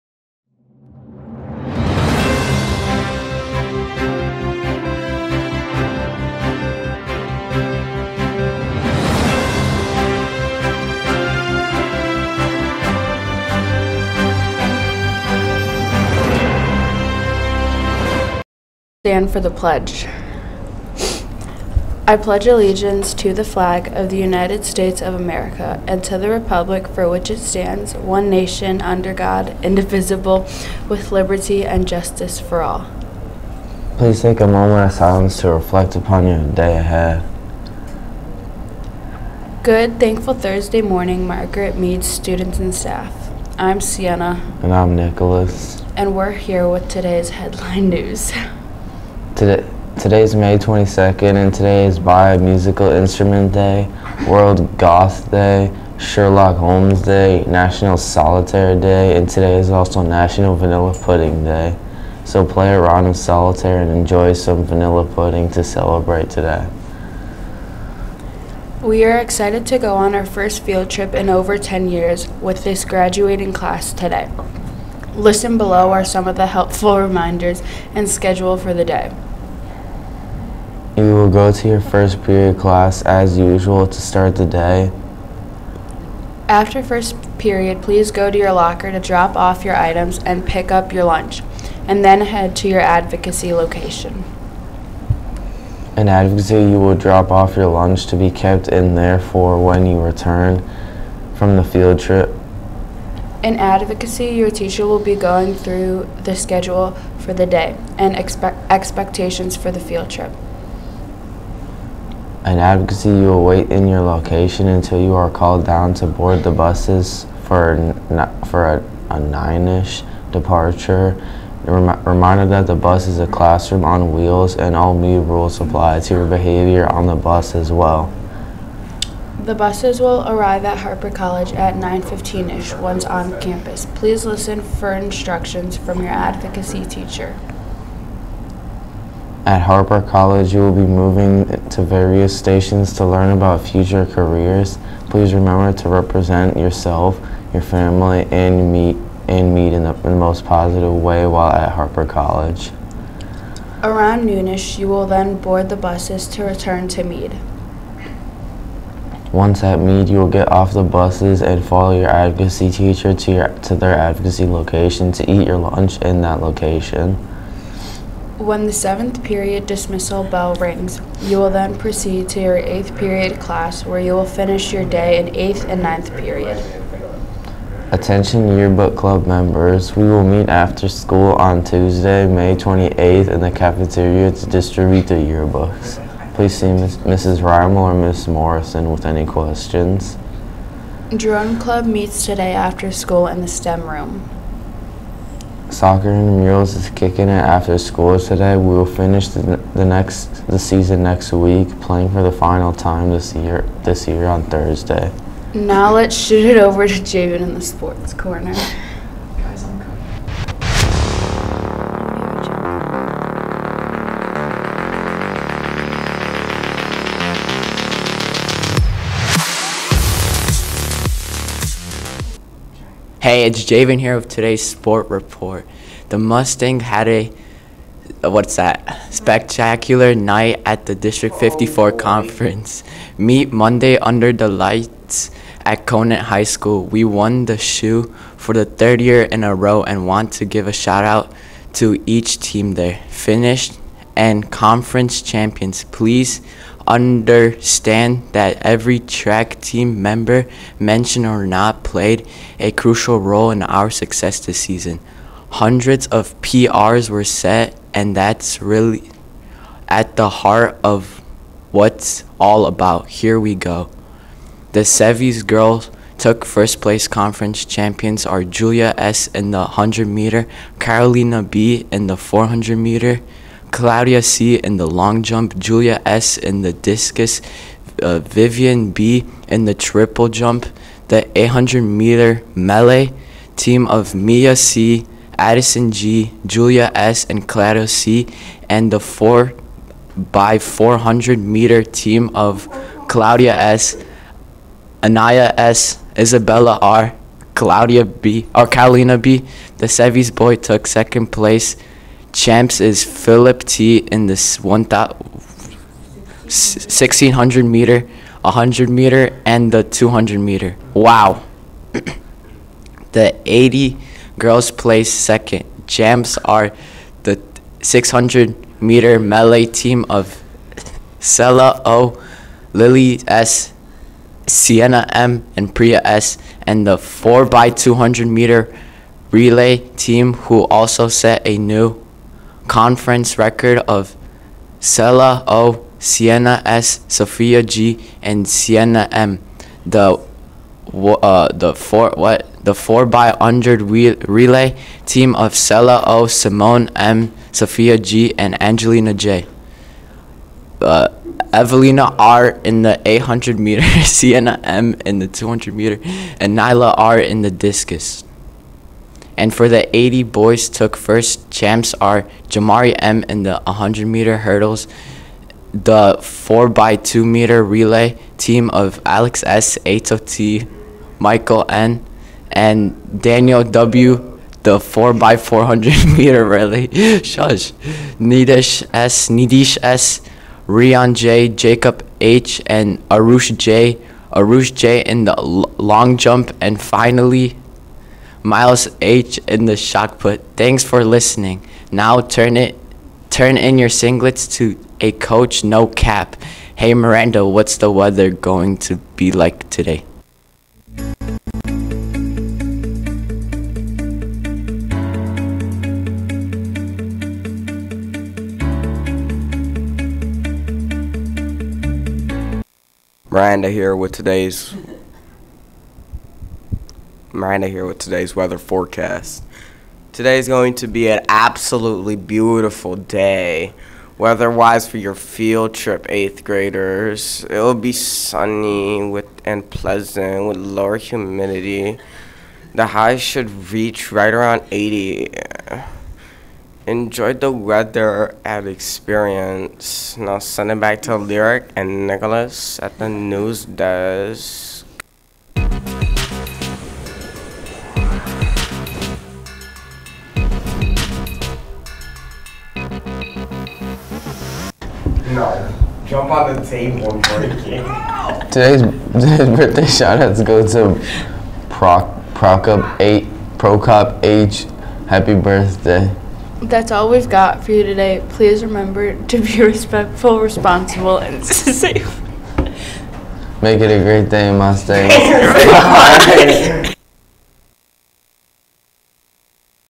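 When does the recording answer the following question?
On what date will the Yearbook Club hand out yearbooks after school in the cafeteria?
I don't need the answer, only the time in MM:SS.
03:01.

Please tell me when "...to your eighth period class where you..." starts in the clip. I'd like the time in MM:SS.
02:52.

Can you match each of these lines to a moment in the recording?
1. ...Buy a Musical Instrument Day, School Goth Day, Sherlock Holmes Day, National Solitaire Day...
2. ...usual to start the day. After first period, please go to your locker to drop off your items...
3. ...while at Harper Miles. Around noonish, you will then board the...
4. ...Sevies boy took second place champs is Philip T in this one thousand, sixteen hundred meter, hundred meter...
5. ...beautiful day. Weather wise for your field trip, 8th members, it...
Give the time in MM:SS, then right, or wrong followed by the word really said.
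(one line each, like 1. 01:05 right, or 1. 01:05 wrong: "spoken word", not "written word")
1. 00:51 wrong: "World", not "School"
2. 01:23 right
3. 02:31 wrong: "College", not "Miles"
4. 04:59 right
5. 07:02 wrong: "graders", not "members".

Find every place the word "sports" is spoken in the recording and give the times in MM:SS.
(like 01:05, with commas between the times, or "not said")
03:27, 03:44.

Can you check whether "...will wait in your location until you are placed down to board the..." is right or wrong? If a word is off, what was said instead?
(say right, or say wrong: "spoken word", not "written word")
wrong: "called", not "placed".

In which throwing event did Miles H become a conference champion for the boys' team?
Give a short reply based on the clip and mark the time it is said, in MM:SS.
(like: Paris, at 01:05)
shot put, at 06:29.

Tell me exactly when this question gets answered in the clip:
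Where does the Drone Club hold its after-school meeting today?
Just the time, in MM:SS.
03:13.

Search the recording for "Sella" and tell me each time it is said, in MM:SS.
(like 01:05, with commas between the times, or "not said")
05:34, 05:45.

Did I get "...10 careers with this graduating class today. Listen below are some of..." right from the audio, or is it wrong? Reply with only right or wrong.
wrong.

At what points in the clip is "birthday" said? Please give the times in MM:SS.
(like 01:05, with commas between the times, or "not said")
07:39, 07:45.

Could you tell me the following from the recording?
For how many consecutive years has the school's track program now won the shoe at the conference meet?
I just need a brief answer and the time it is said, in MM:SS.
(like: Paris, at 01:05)
3, at 03:58.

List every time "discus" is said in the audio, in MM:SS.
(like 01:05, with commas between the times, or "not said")
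04:36, 05:57.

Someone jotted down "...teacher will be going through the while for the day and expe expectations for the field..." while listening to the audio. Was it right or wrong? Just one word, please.
wrong.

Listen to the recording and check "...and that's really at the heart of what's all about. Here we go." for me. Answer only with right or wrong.
right.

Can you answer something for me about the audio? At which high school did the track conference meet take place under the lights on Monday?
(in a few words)
Conant High School.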